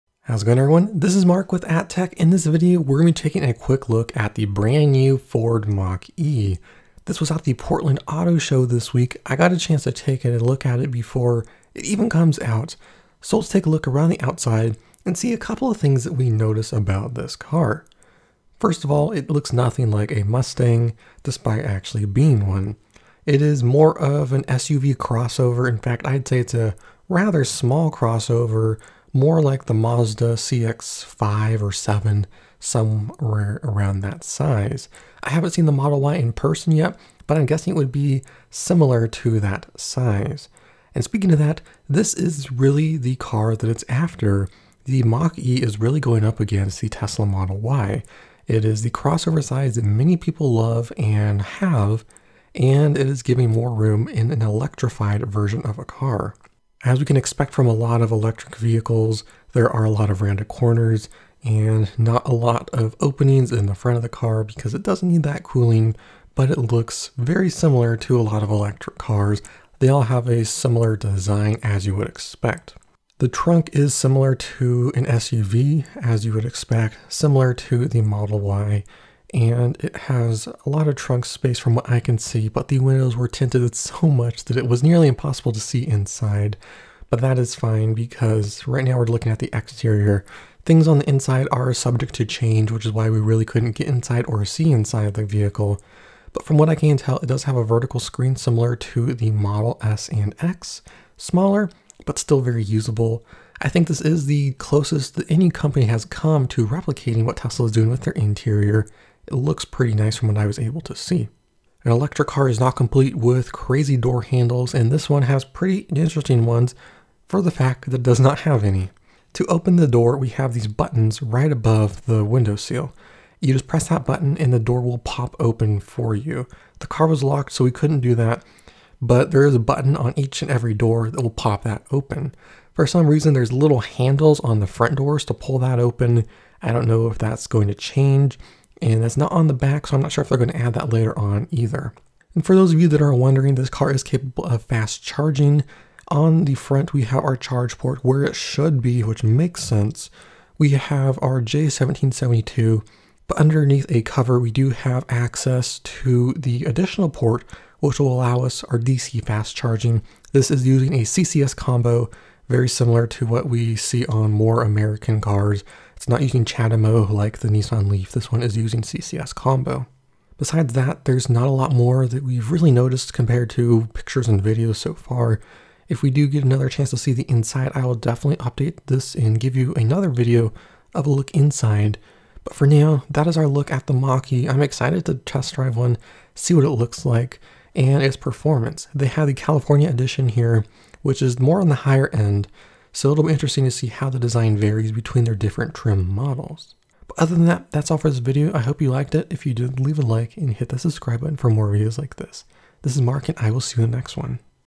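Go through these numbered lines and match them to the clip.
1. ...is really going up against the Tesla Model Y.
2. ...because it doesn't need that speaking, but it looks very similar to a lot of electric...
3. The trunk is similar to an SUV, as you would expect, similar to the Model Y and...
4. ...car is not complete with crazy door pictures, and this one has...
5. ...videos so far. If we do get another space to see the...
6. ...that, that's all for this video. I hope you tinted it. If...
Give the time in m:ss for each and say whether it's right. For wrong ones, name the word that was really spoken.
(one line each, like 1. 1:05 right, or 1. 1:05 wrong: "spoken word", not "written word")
1. 0:45 right
2. 1:04 wrong: "cooling", not "speaking"
3. 1:13 right
4. 1:52 wrong: "handles", not "pictures"
5. 2:54 wrong: "chance", not "space"
6. 3:17 wrong: "liked", not "tinted".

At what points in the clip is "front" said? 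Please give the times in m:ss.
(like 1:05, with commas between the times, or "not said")
1:03, 2:14, 2:26.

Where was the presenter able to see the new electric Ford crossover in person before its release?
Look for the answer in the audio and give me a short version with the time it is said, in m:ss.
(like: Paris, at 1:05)
Portland Auto Show, at 0:07.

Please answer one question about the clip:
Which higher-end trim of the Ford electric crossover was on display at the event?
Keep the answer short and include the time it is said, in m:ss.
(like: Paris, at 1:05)
California edition, at 3:09.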